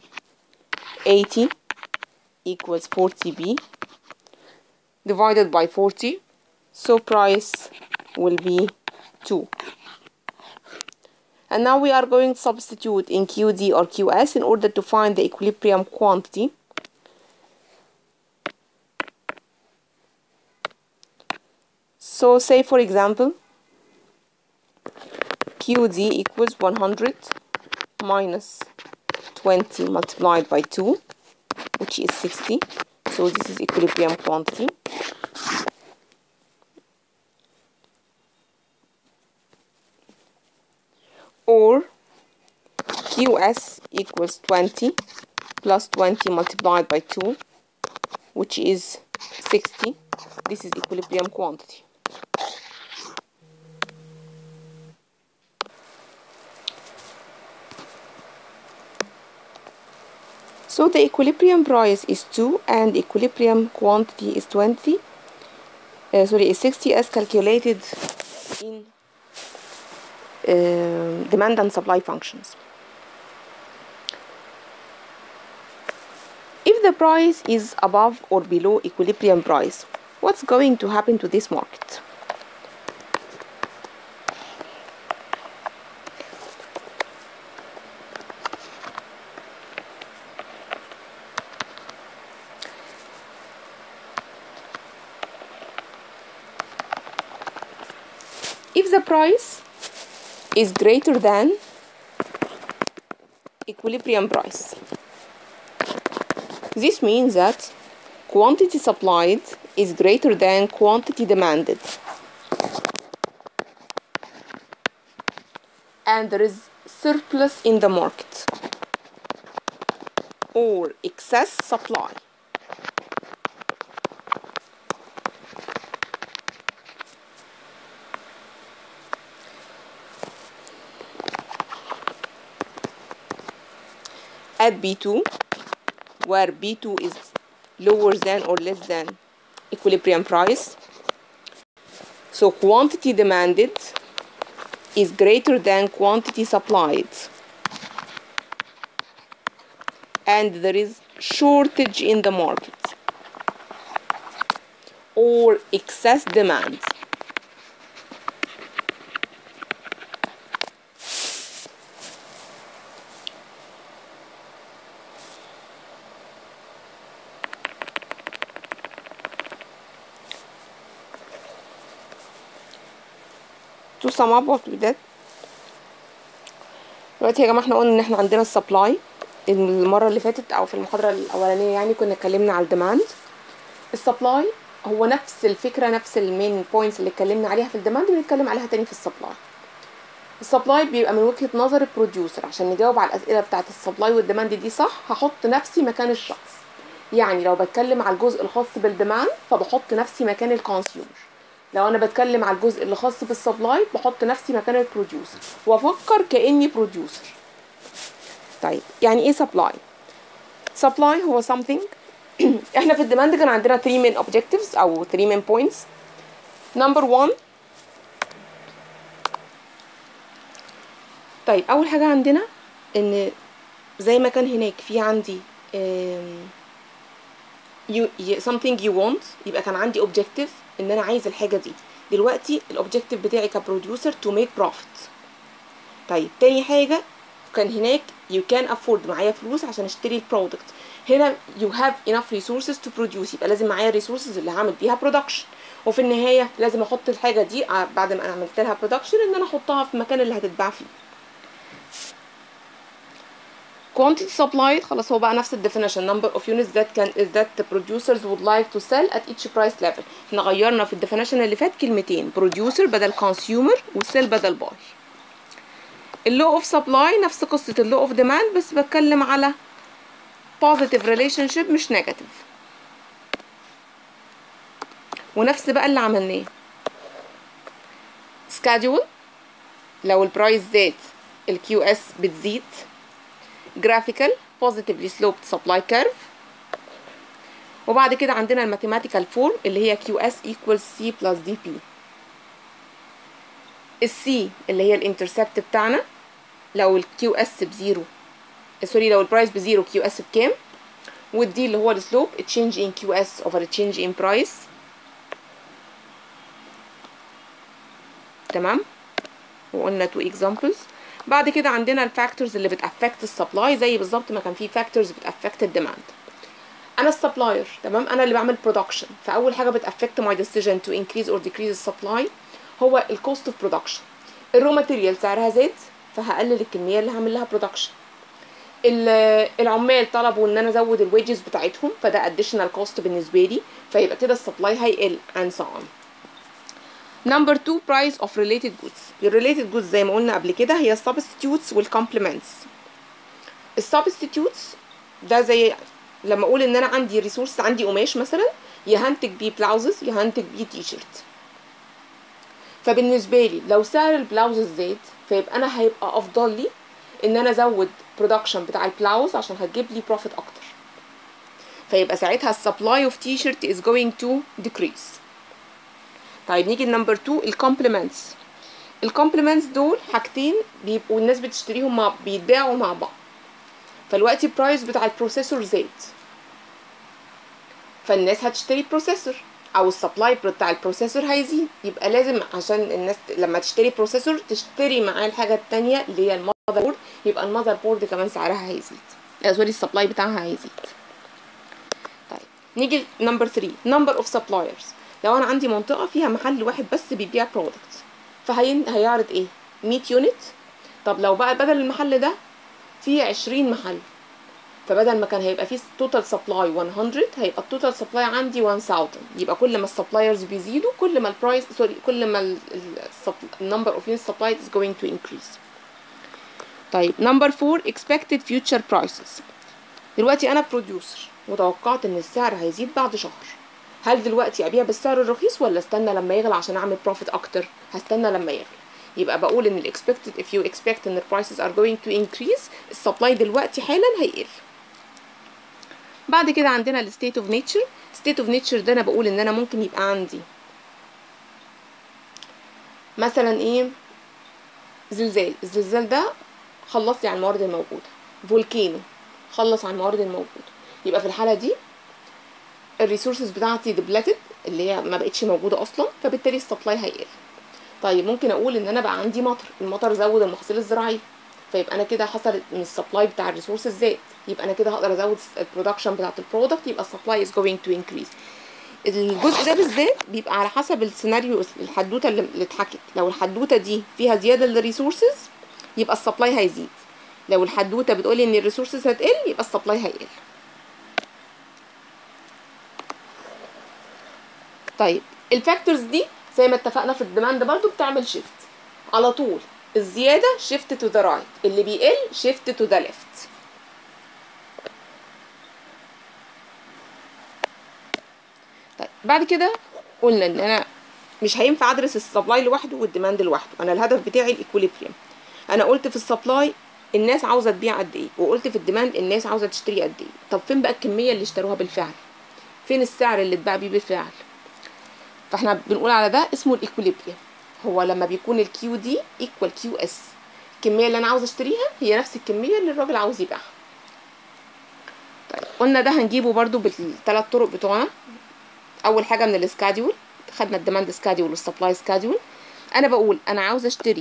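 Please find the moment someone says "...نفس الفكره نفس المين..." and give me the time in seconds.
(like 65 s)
185 s.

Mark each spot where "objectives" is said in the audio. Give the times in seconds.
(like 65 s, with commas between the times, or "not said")
214 s, 230 s.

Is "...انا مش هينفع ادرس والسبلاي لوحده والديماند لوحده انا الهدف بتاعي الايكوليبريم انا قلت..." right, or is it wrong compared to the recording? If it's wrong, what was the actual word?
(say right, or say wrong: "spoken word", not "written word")
wrong: "السبلاي", not "والسبلاي".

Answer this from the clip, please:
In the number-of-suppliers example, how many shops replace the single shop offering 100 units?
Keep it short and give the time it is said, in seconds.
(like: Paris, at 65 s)
20, at 403 s.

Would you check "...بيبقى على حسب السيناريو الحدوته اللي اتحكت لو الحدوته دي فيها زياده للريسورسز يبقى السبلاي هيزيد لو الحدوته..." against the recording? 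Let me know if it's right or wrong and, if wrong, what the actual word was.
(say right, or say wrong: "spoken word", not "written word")
right.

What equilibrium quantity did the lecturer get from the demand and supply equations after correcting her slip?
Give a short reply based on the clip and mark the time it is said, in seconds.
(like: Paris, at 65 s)
60, at 66 s.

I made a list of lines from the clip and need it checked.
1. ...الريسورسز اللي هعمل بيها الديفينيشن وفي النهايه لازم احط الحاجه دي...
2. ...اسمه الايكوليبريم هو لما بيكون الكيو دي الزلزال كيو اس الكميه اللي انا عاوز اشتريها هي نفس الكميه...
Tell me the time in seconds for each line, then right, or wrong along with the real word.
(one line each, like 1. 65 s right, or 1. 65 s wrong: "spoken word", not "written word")
1. 243 s wrong: "برودكشن", not "الديفينيشن"
2. 516 s wrong: "ايكوال", not "الزلزال".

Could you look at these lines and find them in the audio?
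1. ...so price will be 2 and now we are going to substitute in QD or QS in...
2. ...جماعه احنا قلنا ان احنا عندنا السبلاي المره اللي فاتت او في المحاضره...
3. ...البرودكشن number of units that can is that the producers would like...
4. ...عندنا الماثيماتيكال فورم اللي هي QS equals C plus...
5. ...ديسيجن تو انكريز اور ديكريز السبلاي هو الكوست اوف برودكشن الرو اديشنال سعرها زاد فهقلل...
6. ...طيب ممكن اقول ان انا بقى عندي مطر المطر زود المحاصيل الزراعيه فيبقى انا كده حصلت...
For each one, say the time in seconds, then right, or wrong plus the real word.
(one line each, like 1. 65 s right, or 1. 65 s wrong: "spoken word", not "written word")
1. 6 s right
2. 177 s right
3. 255 s wrong: "الديفينيشن", not "البرودكشن"
4. 288 s right
5. 320 s wrong: "ماتيريال", not "اديشنال"
6. 458 s right.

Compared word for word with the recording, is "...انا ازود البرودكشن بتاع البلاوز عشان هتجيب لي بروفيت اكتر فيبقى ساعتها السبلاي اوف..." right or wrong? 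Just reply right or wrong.
wrong.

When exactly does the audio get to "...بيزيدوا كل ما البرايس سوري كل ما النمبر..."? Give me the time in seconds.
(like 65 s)
410 s.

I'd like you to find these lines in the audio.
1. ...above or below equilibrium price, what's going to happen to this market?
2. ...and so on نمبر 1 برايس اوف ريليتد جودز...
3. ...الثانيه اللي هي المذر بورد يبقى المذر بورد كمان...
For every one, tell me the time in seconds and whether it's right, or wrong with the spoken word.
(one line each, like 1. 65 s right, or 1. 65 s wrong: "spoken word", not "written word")
1. 77 s right
2. 335 s wrong: "2", not "1"
3. 385 s right.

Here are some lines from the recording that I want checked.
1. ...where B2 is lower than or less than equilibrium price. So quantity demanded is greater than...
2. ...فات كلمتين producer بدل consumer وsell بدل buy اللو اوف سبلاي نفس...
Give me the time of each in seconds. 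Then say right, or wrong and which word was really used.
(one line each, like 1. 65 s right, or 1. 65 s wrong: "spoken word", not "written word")
1. 136 s right
2. 261 s right.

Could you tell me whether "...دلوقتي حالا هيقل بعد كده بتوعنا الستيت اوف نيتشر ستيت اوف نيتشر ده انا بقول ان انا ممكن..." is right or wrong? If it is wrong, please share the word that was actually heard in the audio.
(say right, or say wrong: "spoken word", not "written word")
wrong: "عندنا", not "بتوعنا".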